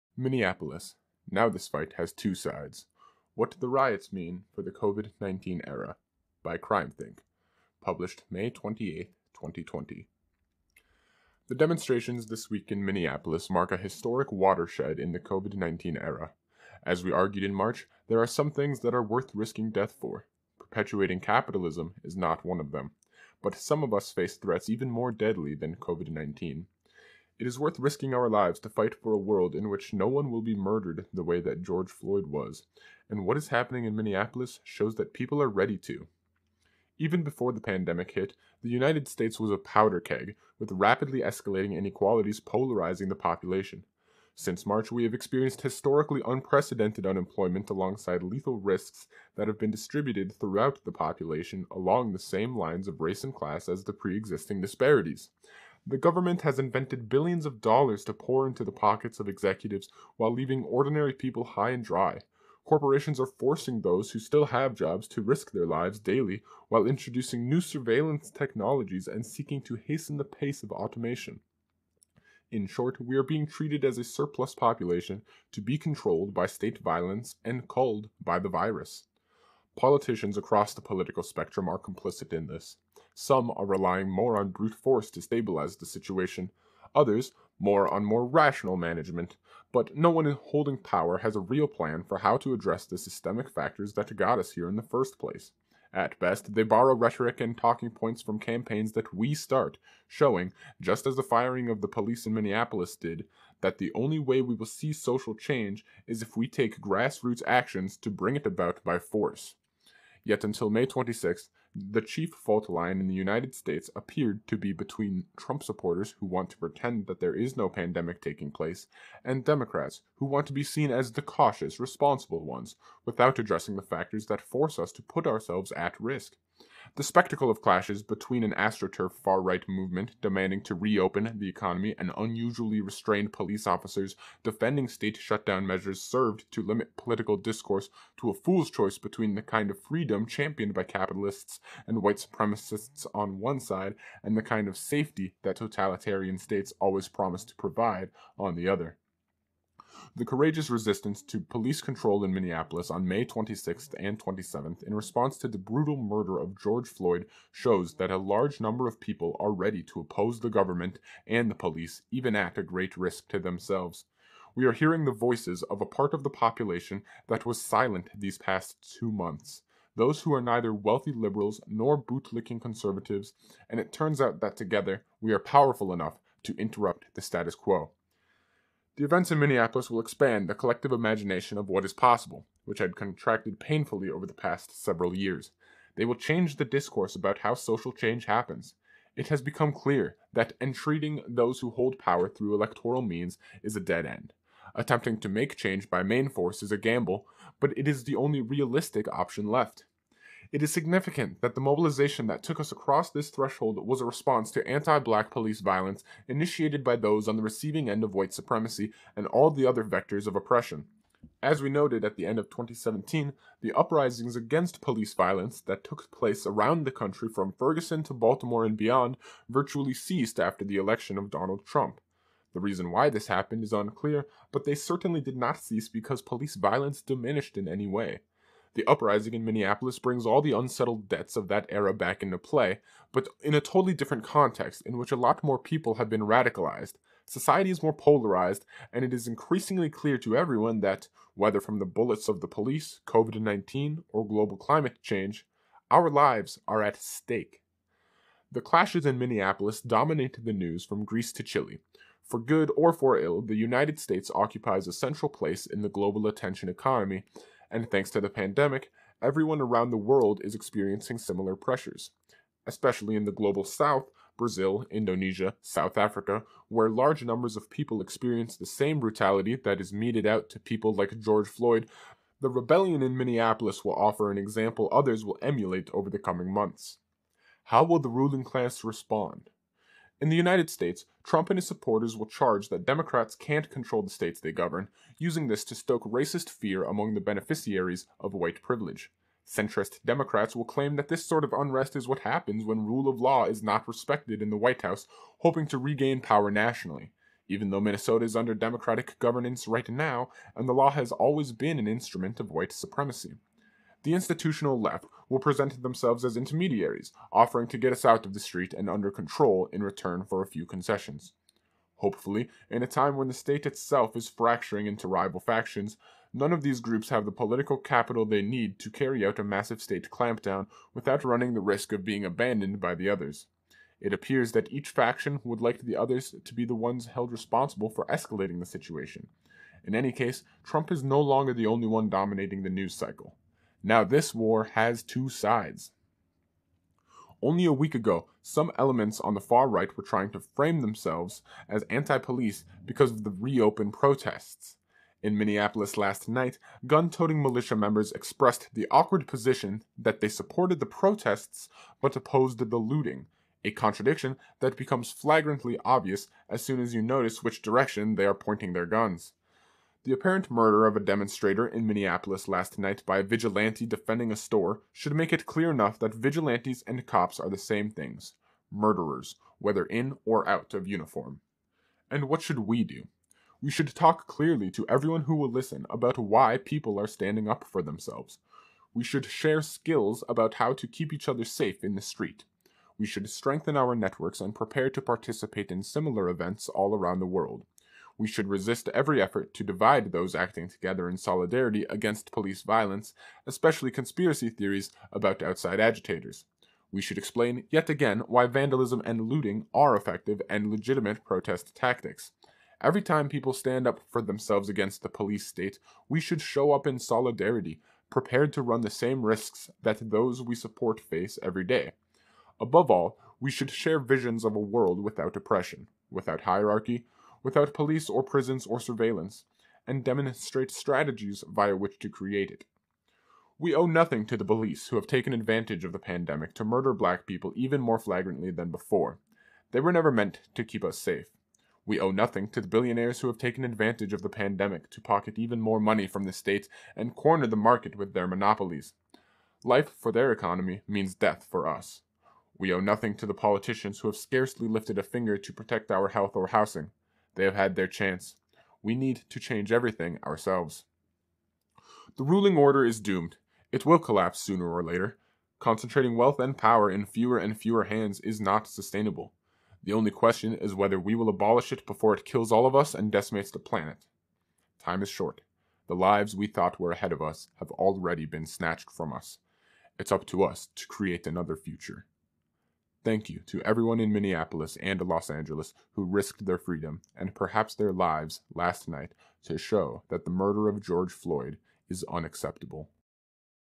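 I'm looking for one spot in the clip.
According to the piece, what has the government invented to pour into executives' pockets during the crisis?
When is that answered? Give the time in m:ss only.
0:57.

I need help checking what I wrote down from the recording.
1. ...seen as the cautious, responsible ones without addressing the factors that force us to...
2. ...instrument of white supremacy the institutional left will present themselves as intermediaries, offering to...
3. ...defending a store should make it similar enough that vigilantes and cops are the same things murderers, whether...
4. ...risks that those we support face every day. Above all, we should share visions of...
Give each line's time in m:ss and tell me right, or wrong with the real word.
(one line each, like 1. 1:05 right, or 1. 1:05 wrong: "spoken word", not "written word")
1. 2:00 right
2. 5:01 right
3. 6:03 wrong: "clear", not "similar"
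4. 6:49 right.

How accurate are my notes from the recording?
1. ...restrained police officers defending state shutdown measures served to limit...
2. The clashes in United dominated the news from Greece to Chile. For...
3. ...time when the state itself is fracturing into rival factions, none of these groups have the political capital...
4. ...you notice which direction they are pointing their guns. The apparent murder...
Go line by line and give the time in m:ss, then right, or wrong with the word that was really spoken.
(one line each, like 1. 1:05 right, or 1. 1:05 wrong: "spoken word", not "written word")
1. 2:12 right
2. 4:08 wrong: "Minneapolis", not "United"
3. 5:12 right
4. 5:56 right.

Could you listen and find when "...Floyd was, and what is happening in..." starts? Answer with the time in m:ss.
0:31.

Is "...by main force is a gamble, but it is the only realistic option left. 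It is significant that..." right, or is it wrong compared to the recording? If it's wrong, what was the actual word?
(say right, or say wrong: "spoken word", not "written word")
right.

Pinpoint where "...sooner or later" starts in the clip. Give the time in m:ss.
7:34.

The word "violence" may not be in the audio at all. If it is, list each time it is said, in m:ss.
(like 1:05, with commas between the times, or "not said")
1:16, 3:25, 3:35, 3:46, 6:32.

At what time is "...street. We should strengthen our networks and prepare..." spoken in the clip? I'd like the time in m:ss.
6:22.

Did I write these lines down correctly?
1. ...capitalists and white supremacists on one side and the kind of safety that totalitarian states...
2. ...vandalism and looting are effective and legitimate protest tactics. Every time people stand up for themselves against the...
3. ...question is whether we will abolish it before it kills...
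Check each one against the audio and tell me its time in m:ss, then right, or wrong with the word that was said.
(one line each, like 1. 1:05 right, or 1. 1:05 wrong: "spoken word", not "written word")
1. 2:20 right
2. 6:38 right
3. 7:40 right.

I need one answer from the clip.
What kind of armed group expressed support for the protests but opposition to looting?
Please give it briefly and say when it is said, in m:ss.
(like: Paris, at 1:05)
militia members, at 5:47.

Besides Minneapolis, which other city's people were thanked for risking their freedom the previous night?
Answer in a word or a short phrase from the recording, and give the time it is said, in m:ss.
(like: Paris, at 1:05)
Los Angeles, at 7:55.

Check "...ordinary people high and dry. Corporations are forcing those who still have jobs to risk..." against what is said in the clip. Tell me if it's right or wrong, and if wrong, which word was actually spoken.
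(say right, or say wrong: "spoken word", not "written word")
right.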